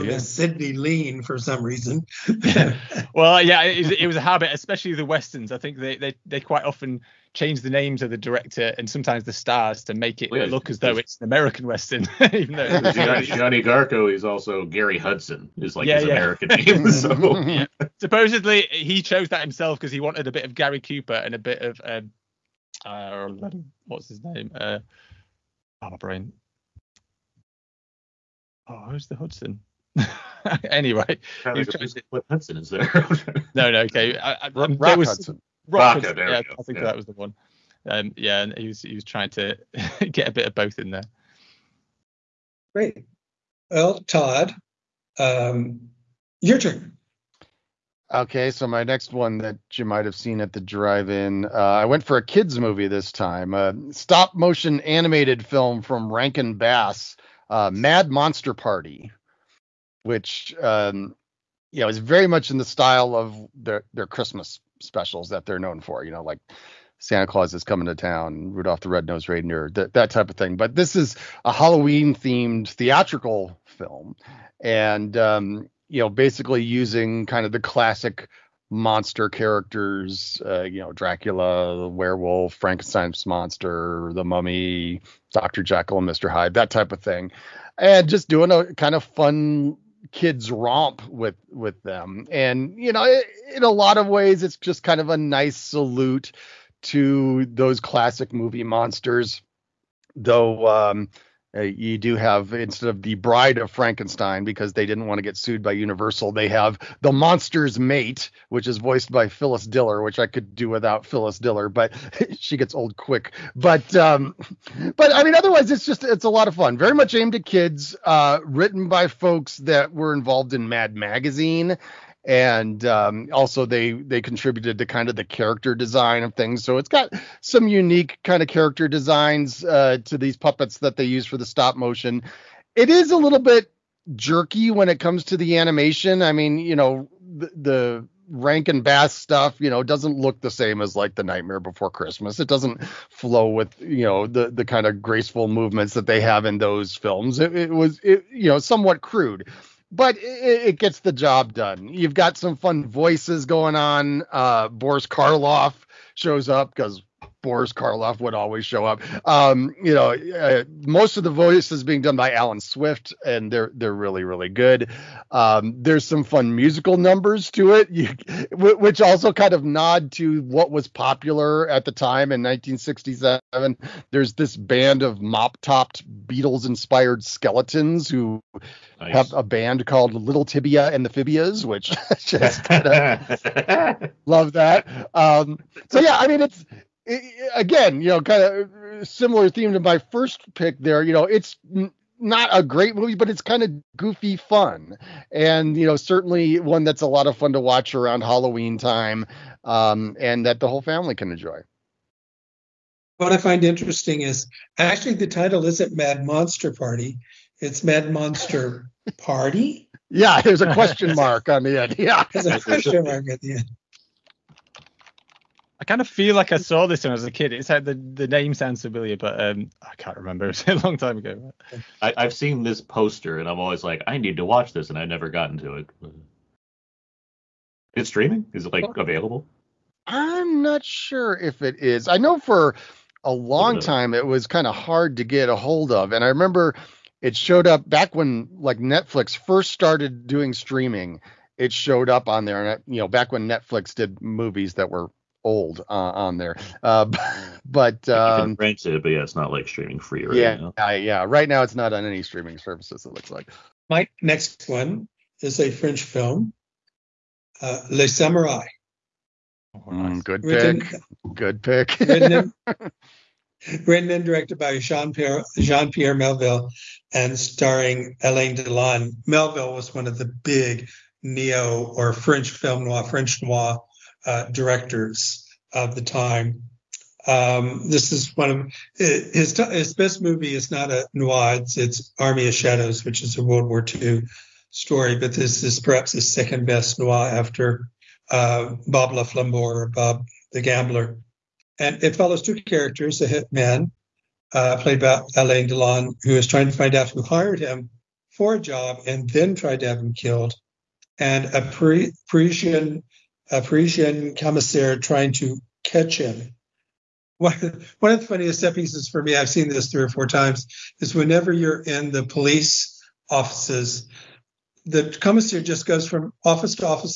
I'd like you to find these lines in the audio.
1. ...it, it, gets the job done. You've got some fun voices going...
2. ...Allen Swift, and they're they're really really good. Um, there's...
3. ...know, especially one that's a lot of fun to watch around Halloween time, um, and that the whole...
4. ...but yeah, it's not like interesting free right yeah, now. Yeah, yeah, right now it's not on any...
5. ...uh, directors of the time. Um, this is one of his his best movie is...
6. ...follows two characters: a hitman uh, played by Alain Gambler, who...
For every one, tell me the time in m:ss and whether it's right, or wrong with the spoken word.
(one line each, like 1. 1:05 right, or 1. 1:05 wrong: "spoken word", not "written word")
1. 2:30 right
2. 2:42 right
3. 3:15 wrong: "certainly", not "especially"
4. 4:09 wrong: "streaming", not "interesting"
5. 4:34 right
6. 4:52 wrong: "Delon", not "Gambler".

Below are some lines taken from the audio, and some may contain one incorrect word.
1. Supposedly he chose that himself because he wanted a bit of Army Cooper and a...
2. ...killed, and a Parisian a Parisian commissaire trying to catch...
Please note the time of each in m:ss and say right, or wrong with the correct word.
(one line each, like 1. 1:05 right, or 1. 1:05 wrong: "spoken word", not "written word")
1. 0:17 wrong: "Gary", not "Army"
2. 5:00 right.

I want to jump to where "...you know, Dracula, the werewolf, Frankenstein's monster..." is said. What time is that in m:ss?
1:20.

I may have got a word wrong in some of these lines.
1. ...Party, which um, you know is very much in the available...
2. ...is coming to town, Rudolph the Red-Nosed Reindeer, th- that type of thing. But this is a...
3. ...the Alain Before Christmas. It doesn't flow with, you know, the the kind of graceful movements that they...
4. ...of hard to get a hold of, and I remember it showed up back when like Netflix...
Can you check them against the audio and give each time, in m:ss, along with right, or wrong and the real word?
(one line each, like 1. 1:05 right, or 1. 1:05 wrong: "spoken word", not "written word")
1. 0:58 wrong: "style", not "available"
2. 1:07 right
3. 2:21 wrong: "Nightmare", not "Alain"
4. 3:54 right.